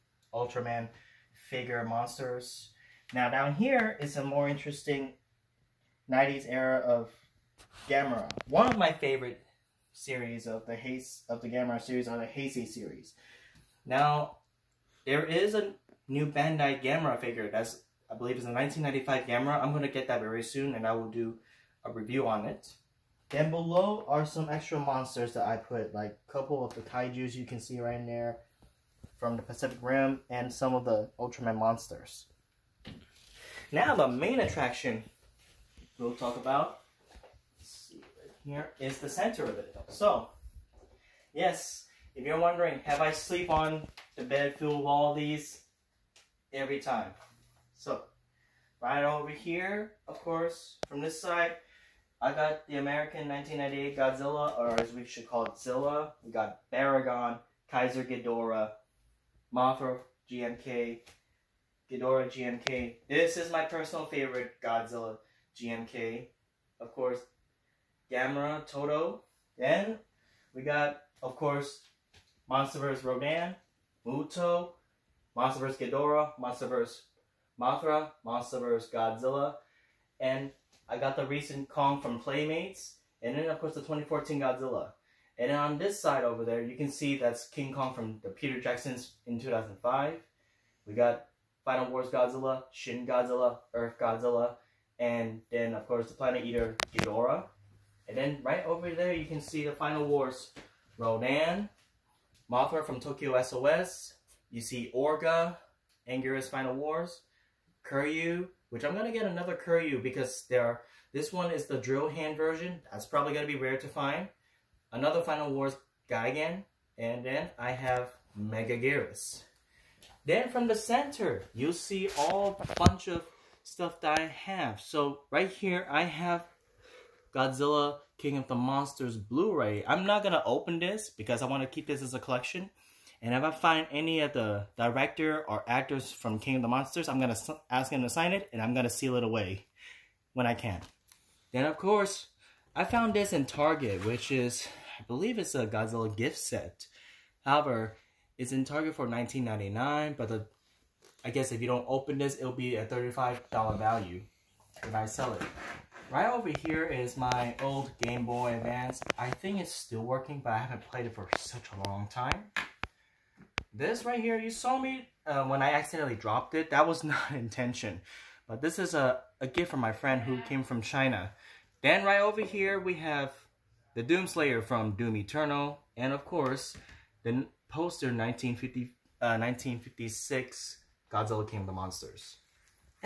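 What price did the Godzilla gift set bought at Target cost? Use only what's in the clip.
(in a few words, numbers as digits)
$19.99.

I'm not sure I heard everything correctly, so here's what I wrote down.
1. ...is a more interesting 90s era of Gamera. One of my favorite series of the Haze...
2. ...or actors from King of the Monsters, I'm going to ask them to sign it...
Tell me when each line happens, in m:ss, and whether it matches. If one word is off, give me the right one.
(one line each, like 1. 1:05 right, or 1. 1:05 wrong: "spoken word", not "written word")
1. 0:03 right
2. 2:15 right.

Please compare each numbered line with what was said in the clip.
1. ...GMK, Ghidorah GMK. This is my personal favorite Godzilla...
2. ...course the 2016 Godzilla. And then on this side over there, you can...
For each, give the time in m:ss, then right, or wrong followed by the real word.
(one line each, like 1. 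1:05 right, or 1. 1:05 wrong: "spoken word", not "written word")
1. 1:00 right
2. 1:23 wrong: "2014", not "2016".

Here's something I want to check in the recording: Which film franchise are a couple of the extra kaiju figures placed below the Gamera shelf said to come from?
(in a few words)
Pacific Rim.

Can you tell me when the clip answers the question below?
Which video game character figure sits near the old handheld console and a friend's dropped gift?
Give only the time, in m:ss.
2:54.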